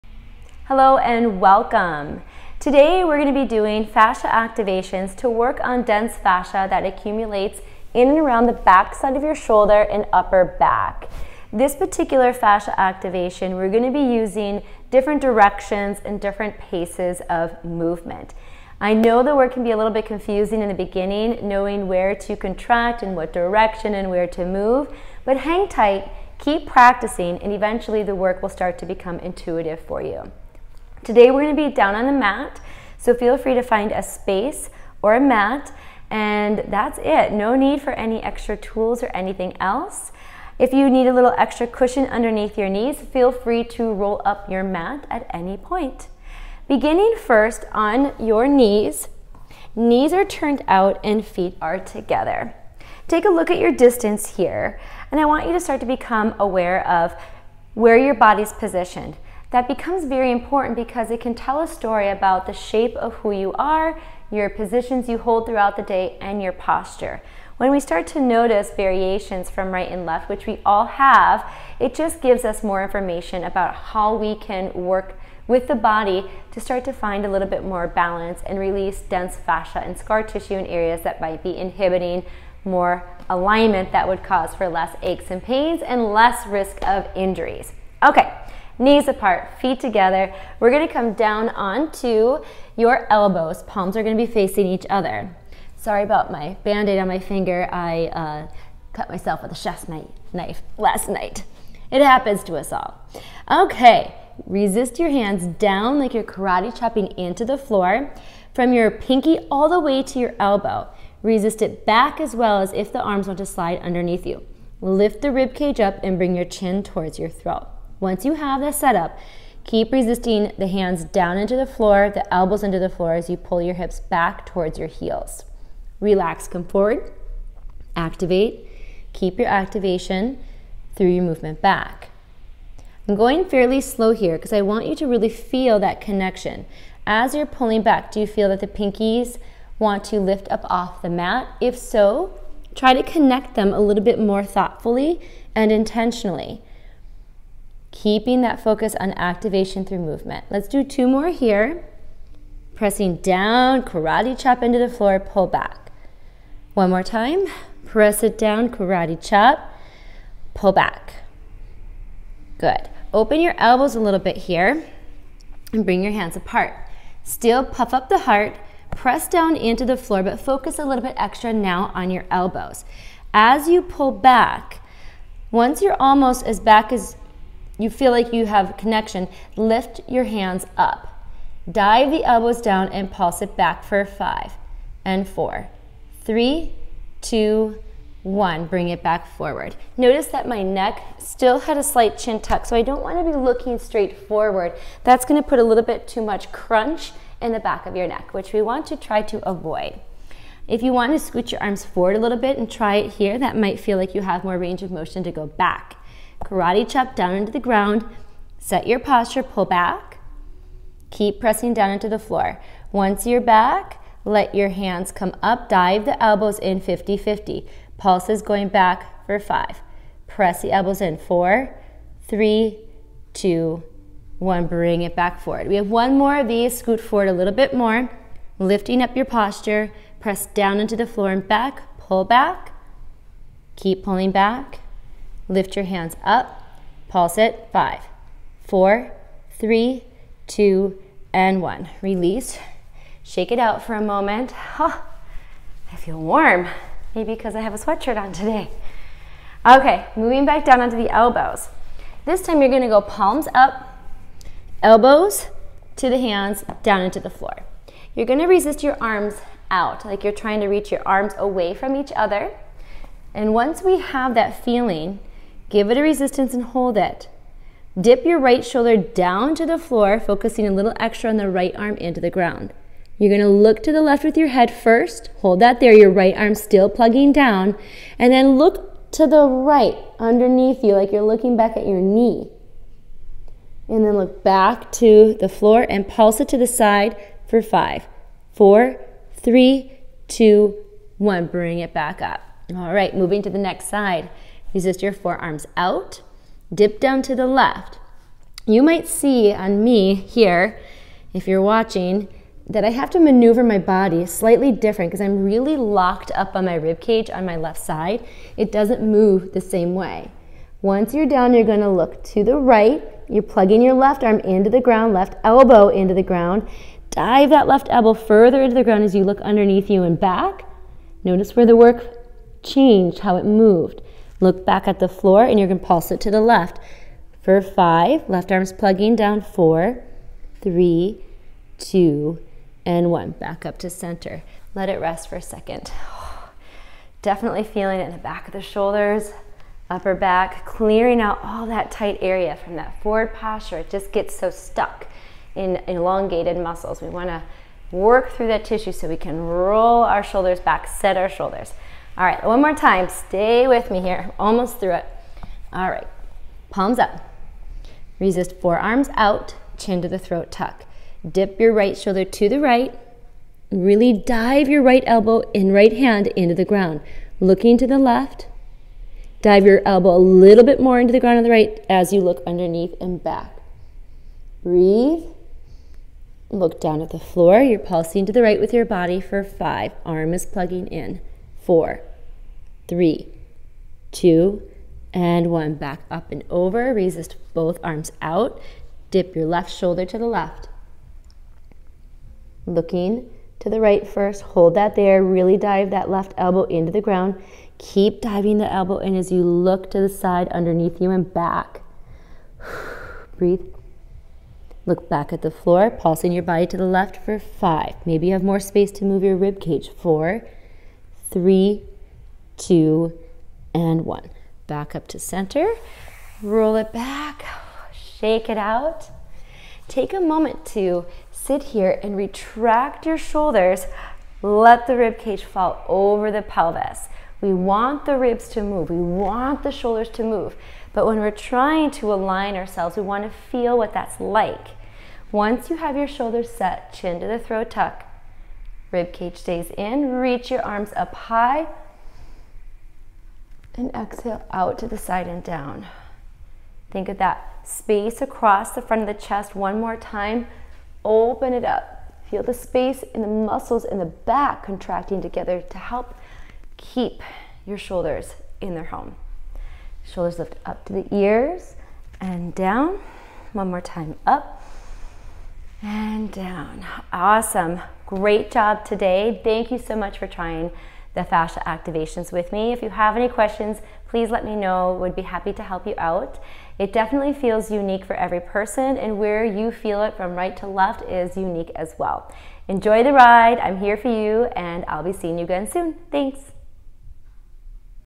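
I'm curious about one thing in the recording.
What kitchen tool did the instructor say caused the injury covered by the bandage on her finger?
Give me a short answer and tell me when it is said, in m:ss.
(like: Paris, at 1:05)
chef's knife, at 1:39.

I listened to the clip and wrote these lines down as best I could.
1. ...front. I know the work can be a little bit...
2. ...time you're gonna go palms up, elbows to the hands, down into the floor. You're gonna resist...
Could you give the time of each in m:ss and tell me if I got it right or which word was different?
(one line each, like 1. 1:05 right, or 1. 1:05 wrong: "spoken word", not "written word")
1. 0:17 wrong: "movement", not "front"
2. 4:12 right.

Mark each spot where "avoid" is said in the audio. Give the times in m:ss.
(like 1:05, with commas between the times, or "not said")
3:19.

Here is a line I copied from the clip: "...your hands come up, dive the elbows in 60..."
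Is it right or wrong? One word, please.
wrong.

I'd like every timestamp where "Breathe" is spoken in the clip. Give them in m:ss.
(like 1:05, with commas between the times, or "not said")
6:14, 6:43.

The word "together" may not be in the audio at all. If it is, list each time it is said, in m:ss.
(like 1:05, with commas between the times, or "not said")
0:51, 1:29, 7:35.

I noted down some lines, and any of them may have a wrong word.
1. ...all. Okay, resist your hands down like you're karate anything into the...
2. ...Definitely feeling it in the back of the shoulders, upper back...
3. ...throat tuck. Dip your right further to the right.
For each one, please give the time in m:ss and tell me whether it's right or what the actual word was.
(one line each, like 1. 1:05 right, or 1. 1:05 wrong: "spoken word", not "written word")
1. 1:42 wrong: "chopping", not "anything"
2. 5:37 right
3. 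6:00 wrong: "shoulder", not "further".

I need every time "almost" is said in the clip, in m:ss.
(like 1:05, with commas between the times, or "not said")
2:55, 5:54.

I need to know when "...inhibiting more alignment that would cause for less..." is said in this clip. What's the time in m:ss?
1:21.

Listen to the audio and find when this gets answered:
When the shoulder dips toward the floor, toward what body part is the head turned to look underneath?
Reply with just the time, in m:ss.
4:41.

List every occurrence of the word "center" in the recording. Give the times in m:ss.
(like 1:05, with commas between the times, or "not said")
5:33, 6:55.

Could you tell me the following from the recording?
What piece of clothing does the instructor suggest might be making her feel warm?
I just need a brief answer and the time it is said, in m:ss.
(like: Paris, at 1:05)
sweatshirt, at 4:07.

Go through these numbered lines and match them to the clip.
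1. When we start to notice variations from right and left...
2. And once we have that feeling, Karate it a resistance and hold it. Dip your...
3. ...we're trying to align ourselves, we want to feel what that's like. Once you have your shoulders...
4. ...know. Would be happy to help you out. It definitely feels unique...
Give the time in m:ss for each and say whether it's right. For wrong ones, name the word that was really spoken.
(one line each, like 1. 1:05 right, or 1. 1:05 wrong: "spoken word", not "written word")
1. 1:07 right
2. 4:23 wrong: "Give", not "Karate"
3. 7:11 right
4. 7:54 right.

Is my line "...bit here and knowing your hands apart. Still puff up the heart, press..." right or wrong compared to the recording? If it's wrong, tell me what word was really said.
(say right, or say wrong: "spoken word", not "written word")
wrong: "bring", not "knowing".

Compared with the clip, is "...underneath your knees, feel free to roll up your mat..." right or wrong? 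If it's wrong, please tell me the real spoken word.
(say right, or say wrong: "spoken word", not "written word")
right.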